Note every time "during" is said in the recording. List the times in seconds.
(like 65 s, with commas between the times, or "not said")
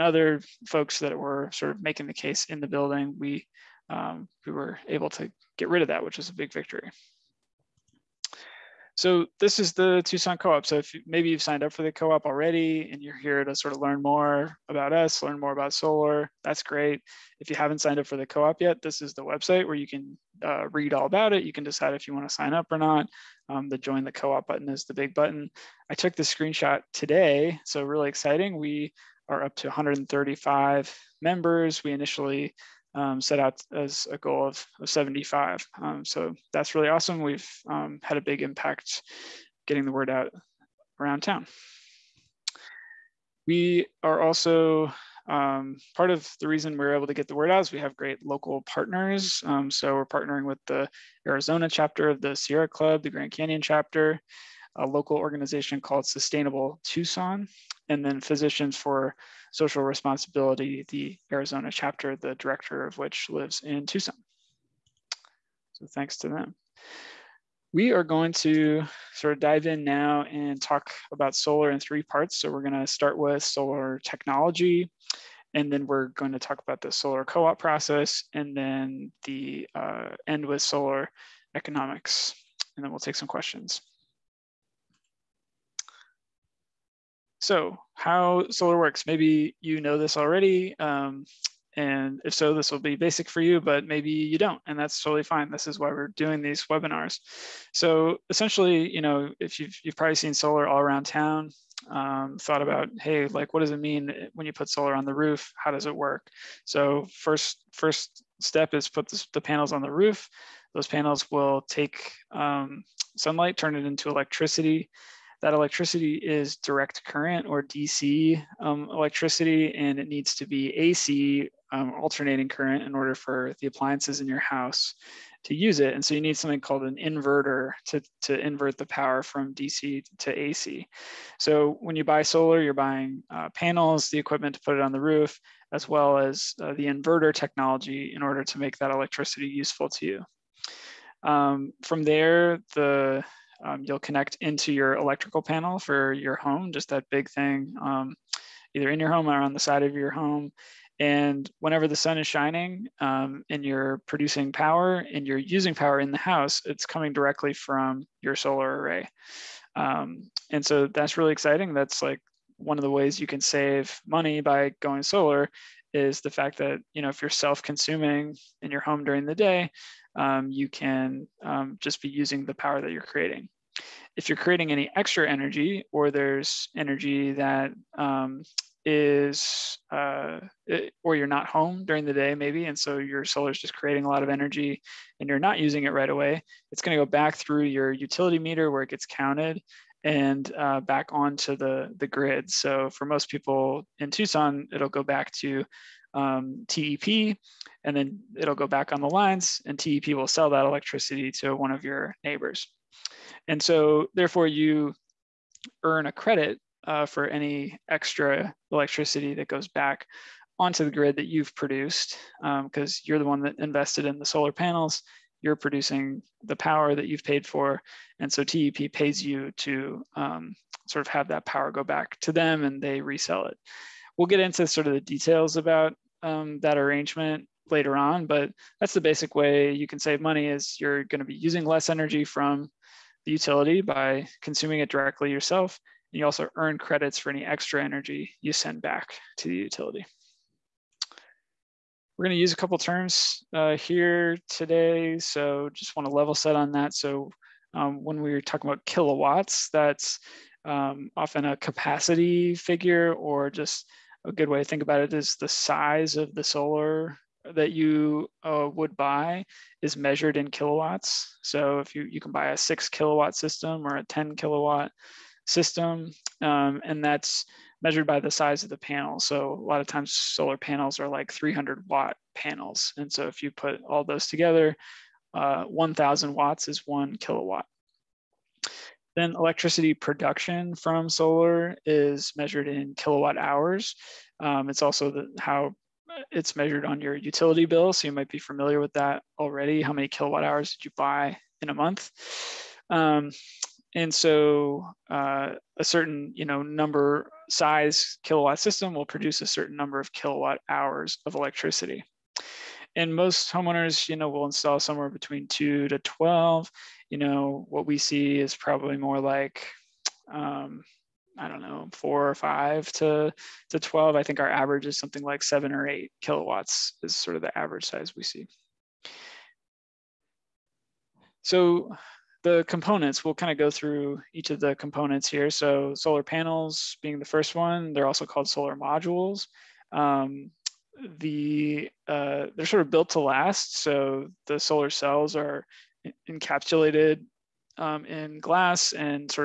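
169 s, 181 s.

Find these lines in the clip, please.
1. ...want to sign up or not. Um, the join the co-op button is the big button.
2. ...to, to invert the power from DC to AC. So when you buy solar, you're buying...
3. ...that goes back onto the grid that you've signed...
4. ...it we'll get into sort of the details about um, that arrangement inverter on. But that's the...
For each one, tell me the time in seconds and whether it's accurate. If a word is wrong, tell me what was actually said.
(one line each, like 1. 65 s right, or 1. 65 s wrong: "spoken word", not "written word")
1. 22 s right
2. 127 s right
3. 209 s wrong: "produced", not "signed"
4. 223 s wrong: "later", not "inverter".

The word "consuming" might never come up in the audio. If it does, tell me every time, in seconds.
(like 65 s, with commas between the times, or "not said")
167 s, 234 s.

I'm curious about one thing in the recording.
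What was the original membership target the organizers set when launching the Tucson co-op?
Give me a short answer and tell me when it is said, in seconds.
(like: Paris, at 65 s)
75, at 34 s.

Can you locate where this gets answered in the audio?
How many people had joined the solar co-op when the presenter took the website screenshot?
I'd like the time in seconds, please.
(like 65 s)
29 s.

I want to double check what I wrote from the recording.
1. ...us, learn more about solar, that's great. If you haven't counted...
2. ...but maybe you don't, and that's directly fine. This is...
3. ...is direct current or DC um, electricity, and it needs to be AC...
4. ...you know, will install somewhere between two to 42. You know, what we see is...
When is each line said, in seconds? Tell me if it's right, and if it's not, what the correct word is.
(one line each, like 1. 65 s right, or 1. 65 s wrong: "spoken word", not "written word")
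1. 14 s wrong: "signed", not "counted"
2. 93 s wrong: "totally", not "directly"
3. 116 s right
4. 304 s wrong: "12", not "42".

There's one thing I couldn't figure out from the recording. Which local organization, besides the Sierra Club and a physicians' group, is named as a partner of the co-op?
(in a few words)
Sustainable Tucson.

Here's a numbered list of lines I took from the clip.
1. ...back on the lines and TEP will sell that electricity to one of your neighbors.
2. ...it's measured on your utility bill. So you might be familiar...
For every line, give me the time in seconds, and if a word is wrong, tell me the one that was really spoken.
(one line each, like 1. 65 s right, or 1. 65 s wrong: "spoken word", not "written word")
1. 198 s right
2. 286 s right.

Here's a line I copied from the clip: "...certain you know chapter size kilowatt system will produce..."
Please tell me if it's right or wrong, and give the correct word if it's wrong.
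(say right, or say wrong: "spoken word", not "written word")
wrong: "number", not "chapter".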